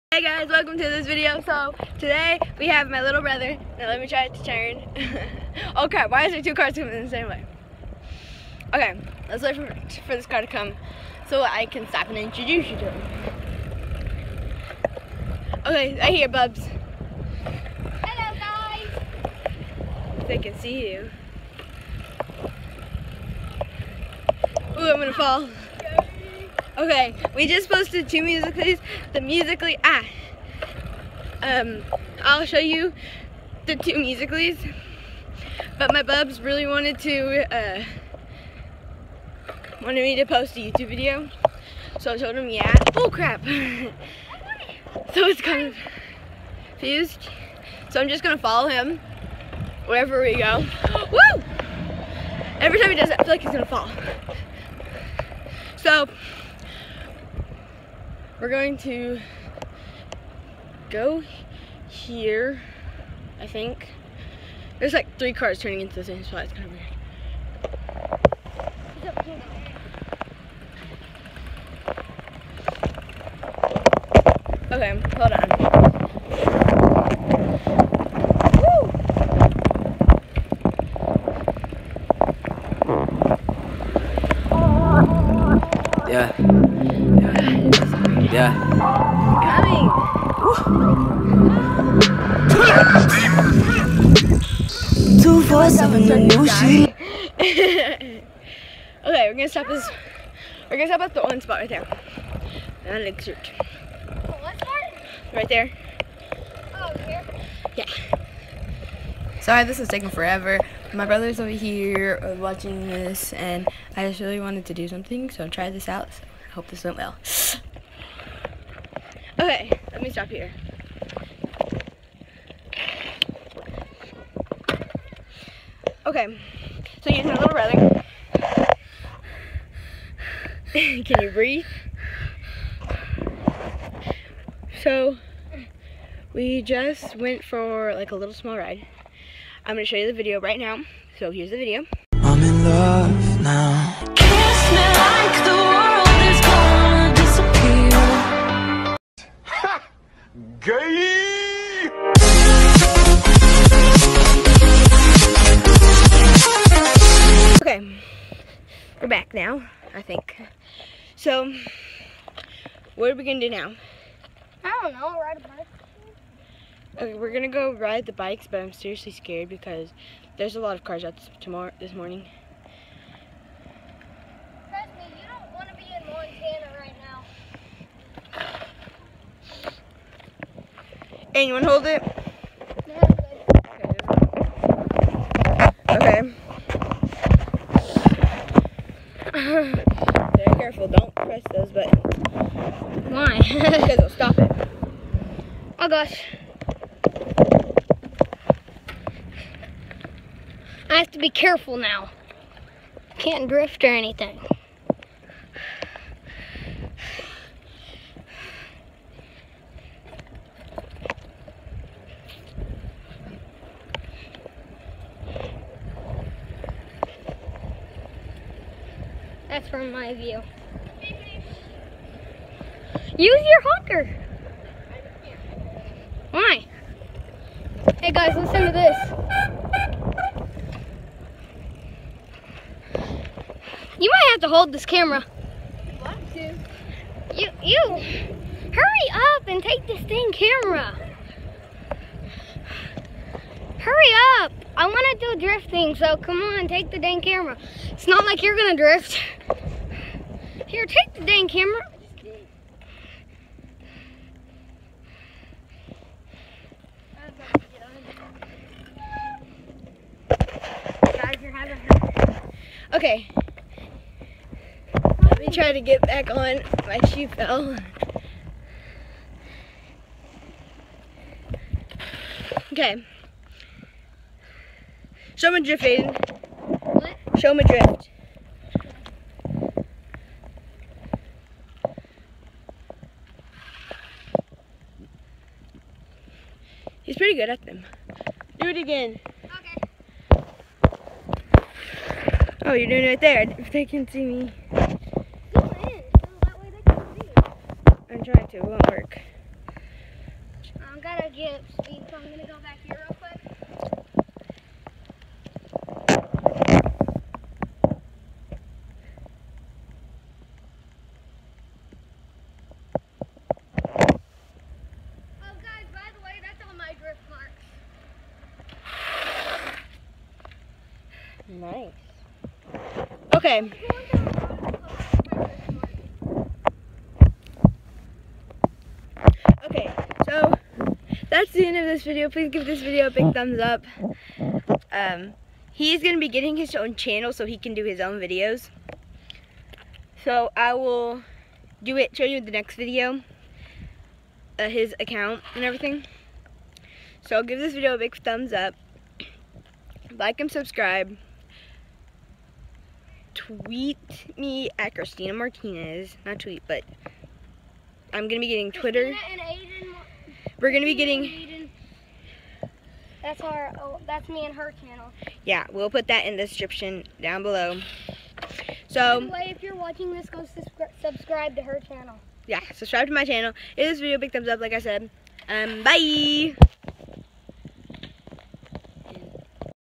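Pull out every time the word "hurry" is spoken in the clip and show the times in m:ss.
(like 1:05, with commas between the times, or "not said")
3:57, 4:03.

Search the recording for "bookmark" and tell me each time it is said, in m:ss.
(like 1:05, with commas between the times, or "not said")
not said.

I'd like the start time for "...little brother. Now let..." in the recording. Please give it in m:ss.
0:03.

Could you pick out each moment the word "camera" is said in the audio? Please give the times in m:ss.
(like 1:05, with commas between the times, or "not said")
3:54, 4:00, 4:07, 4:11.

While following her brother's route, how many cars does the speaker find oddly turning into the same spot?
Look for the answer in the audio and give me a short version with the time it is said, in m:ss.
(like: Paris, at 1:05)
3, at 1:05.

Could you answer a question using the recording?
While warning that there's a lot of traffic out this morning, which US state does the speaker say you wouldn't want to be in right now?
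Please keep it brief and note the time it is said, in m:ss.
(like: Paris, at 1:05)
Montana, at 2:56.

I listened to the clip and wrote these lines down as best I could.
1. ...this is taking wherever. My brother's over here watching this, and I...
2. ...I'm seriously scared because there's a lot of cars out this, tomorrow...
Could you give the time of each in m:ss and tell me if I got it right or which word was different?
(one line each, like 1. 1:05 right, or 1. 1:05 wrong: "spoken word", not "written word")
1. 1:49 wrong: "forever", not "wherever"
2. 2:48 right.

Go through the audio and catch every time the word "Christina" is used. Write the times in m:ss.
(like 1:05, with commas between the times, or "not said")
5:54.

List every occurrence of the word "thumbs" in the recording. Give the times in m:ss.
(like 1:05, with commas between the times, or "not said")
5:33, 5:48, 6:14.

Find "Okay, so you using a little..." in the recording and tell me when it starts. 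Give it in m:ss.
2:06.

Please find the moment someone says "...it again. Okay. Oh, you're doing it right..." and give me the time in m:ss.
4:48.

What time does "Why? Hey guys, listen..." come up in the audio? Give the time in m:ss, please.
3:46.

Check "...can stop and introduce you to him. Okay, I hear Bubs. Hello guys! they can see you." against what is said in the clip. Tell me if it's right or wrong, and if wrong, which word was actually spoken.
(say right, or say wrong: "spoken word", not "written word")
right.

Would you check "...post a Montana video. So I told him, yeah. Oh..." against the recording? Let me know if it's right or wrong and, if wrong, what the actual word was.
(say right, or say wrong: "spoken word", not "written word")
wrong: "YouTube", not "Montana".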